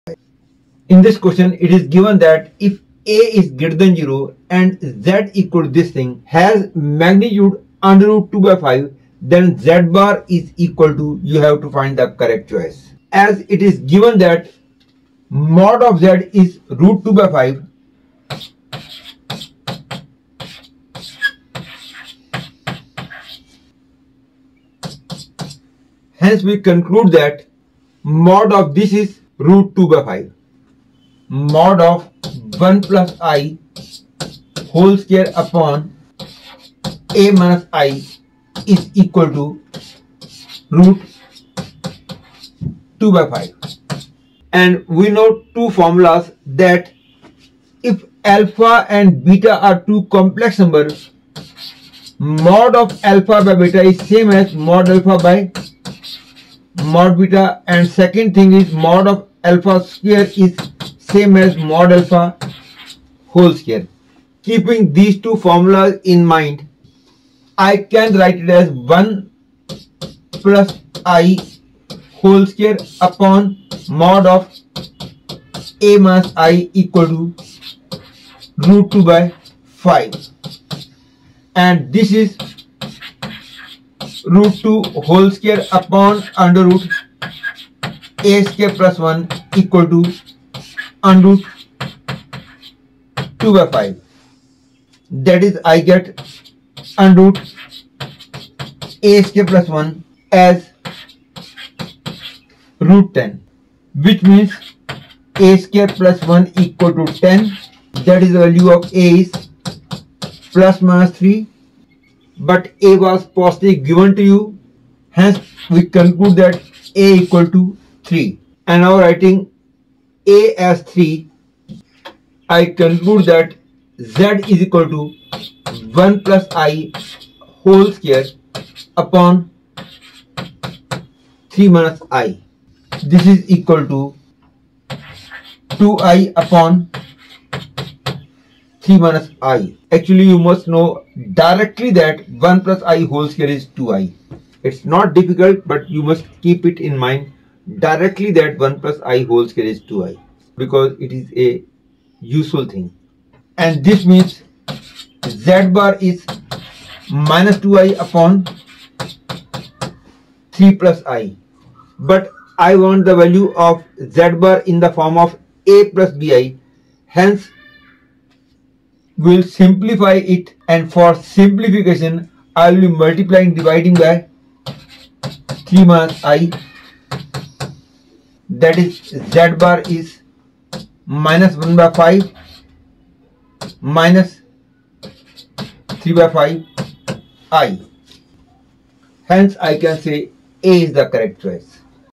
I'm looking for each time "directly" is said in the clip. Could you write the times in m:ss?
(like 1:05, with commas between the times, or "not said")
2:21, 2:27.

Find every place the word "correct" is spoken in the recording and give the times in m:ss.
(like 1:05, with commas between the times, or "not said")
0:12, 3:11.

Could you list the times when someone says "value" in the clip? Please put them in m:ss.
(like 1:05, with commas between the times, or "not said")
1:48, 2:43.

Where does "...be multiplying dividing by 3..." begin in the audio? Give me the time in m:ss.
2:52.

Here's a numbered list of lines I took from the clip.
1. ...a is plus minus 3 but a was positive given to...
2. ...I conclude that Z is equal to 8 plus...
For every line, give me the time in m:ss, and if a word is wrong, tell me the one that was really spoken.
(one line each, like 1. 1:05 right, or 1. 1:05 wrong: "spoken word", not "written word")
1. 1:48 right
2. 2:02 wrong: "1", not "8".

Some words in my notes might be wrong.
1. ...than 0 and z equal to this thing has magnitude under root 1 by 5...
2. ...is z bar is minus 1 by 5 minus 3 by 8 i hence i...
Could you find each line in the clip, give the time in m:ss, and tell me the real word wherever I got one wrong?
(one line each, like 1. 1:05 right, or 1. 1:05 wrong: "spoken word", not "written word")
1. 0:03 wrong: "2", not "1"
2. 2:58 wrong: "5", not "8".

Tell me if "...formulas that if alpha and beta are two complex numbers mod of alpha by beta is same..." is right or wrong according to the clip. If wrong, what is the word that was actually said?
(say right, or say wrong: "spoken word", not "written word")
right.